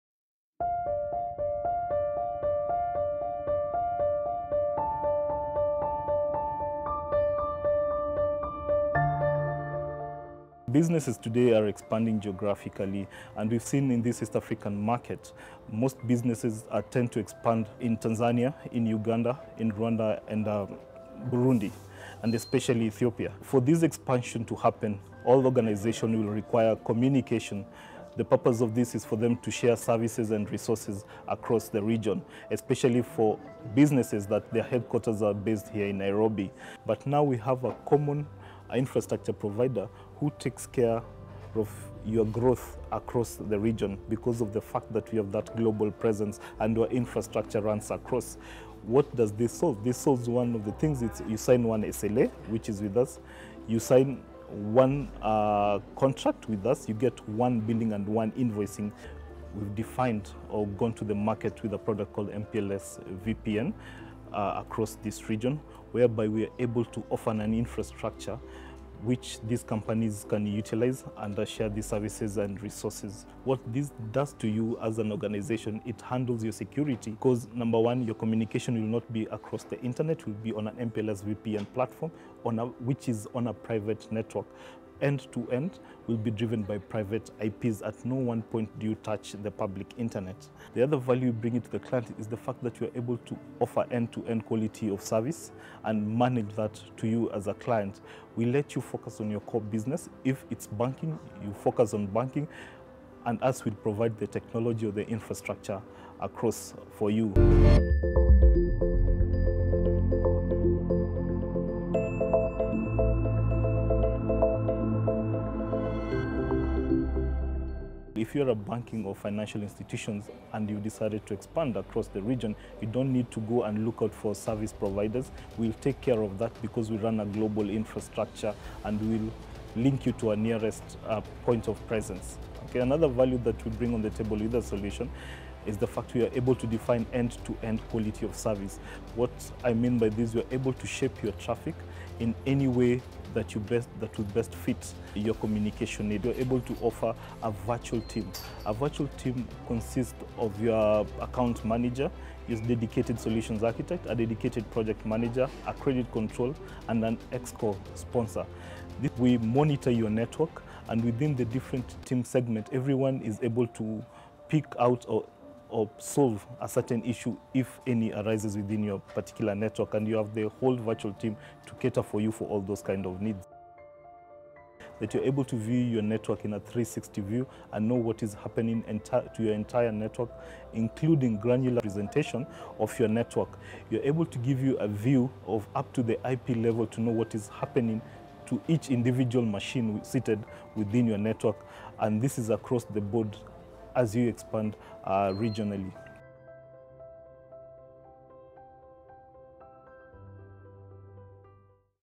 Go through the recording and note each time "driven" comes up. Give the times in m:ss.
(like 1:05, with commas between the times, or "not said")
1:26.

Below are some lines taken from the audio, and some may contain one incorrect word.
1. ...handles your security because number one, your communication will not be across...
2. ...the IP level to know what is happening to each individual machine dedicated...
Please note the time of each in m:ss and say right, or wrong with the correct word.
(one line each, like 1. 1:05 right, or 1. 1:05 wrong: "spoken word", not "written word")
1. 1:16 right
2. 3:06 wrong: "seated", not "dedicated".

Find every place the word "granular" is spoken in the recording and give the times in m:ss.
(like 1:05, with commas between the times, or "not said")
3:01.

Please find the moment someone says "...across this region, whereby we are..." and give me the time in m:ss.
1:04.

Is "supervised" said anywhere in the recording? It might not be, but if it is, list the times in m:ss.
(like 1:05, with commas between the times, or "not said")
not said.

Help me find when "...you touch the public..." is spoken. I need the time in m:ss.
1:28.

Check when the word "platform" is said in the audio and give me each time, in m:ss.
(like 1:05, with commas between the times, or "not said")
1:21.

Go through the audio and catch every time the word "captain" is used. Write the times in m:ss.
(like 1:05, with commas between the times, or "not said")
not said.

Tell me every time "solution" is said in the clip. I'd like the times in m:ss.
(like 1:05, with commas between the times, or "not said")
2:14, 2:33.